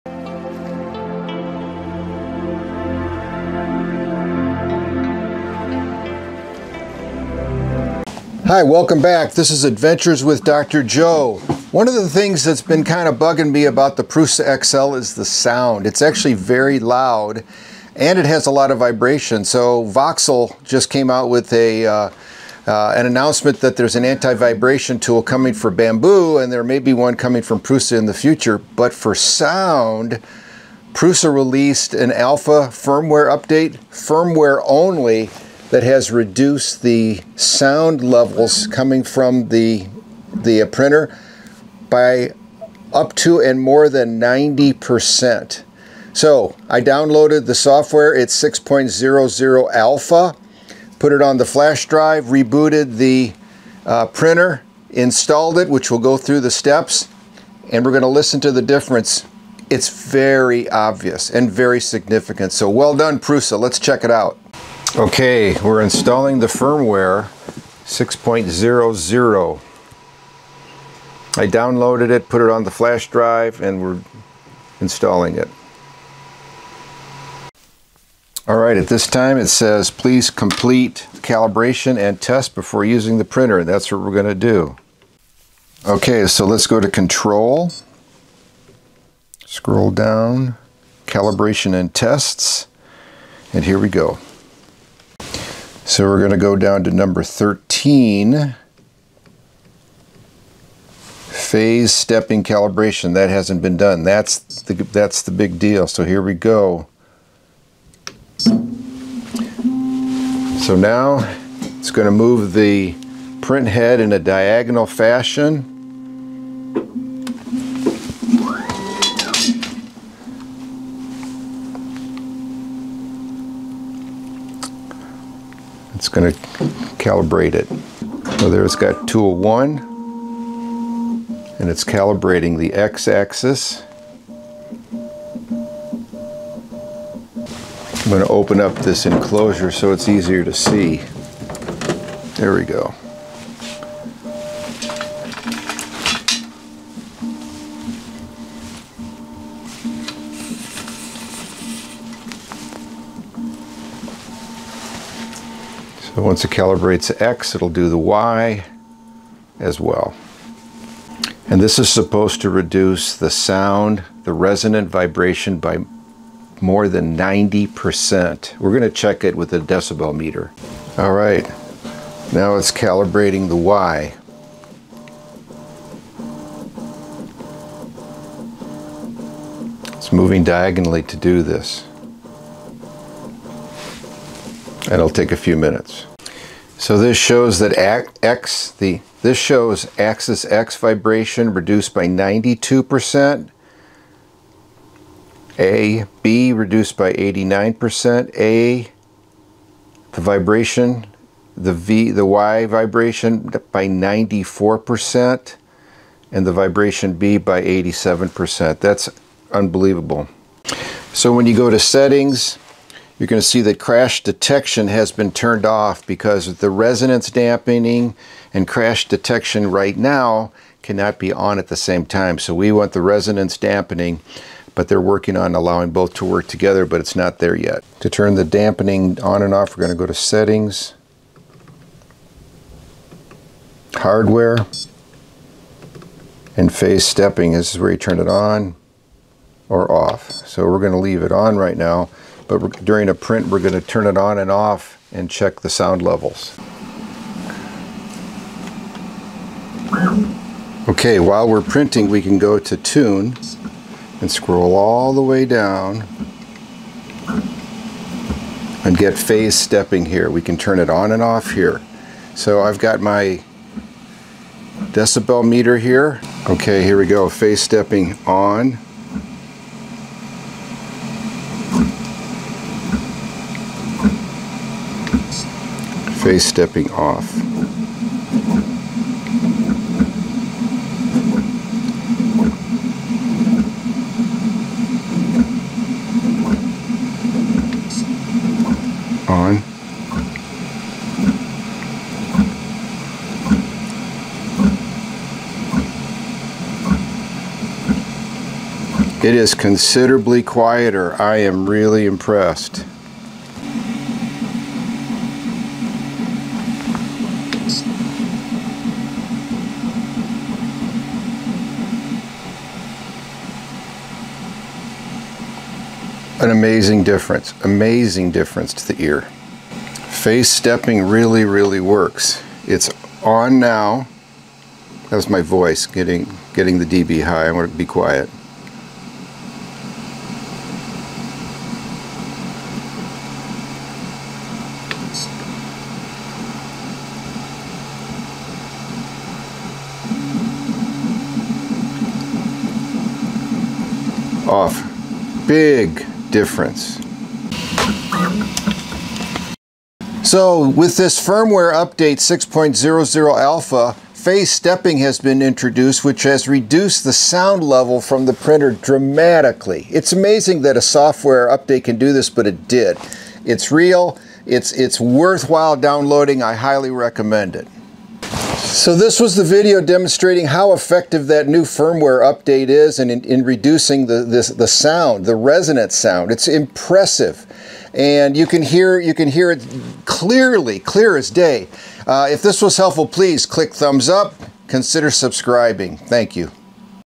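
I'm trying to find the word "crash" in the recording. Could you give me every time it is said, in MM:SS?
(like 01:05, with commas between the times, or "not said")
03:33, 03:38.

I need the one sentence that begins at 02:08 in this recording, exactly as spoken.
So there's it got tool one, and it's calibrating the x-axis.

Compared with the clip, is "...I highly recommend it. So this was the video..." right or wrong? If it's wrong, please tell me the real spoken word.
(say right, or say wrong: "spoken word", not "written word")
right.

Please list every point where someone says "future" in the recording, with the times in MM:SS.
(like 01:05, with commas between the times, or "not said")
00:28.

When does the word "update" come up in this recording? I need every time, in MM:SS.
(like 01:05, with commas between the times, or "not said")
00:33, 05:51, 06:01, 06:12.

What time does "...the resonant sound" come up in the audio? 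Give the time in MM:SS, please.
06:15.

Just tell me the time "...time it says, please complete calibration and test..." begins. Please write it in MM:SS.
01:19.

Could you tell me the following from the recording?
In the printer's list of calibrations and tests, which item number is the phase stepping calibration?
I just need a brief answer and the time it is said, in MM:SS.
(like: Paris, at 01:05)
13, at 01:36.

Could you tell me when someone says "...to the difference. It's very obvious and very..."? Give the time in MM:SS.
00:58.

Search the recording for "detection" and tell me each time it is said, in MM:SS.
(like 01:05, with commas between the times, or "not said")
03:34, 03:39.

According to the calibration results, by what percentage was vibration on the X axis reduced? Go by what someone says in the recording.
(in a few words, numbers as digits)
92%.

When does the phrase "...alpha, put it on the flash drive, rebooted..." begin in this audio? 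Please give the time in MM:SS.
00:49.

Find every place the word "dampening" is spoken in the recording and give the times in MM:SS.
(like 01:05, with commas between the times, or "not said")
03:37, 03:43, 03:48.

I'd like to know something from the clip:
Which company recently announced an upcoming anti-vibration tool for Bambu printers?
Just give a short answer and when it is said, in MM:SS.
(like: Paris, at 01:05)
Voxel, at 00:19.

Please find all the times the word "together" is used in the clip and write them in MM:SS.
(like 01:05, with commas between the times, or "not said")
03:46.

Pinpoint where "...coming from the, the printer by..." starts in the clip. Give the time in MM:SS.
00:38.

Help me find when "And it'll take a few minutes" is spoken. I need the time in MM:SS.
03:04.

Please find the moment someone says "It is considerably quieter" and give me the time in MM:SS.
04:59.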